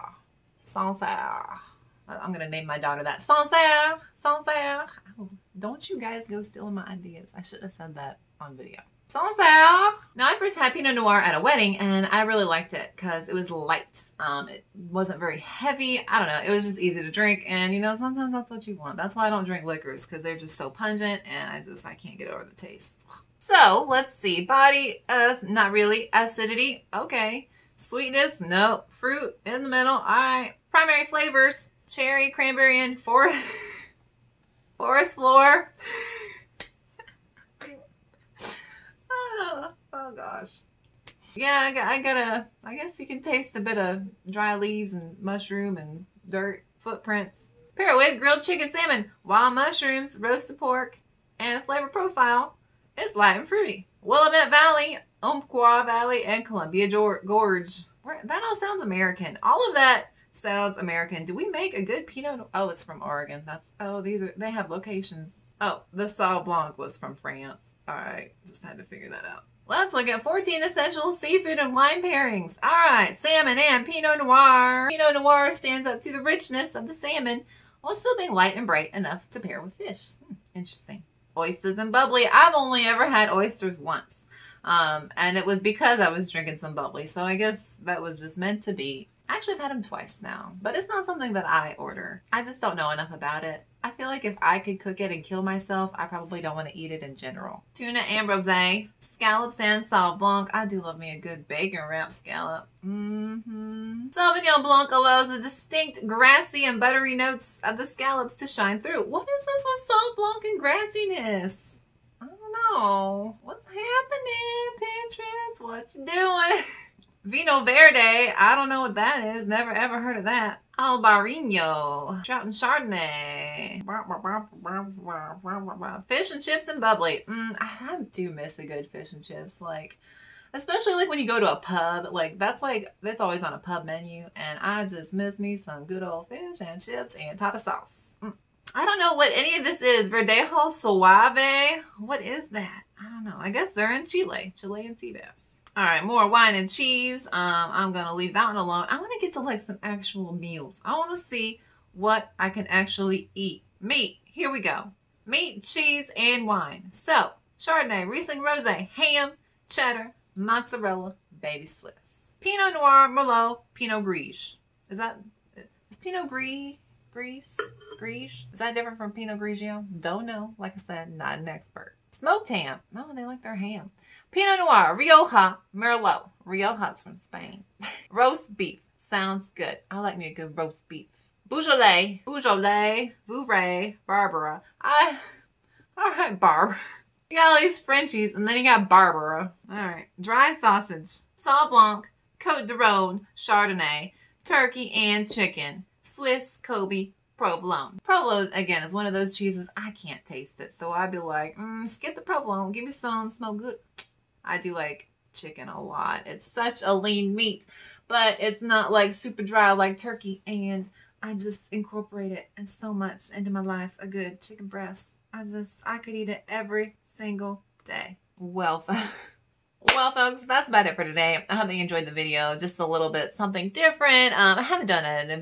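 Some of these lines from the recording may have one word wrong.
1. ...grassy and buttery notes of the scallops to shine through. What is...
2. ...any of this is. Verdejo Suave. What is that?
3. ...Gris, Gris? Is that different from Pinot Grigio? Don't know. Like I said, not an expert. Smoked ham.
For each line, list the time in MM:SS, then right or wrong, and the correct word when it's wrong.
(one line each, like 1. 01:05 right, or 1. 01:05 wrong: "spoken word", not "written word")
1. 01:46 right
2. 02:19 right
3. 02:47 right.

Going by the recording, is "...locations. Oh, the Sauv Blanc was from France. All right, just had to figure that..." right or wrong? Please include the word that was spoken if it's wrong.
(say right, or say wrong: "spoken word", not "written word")
right.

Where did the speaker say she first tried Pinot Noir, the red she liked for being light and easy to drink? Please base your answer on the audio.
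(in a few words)
At a wedding.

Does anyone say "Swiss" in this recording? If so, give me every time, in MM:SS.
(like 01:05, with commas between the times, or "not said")
02:41, 03:16.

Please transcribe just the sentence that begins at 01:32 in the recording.
I just don't know enough about it.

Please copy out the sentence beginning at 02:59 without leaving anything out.
I like me a good roast beef.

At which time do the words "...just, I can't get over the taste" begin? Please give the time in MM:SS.
00:21.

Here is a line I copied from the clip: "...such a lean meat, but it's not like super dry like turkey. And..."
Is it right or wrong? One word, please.
right.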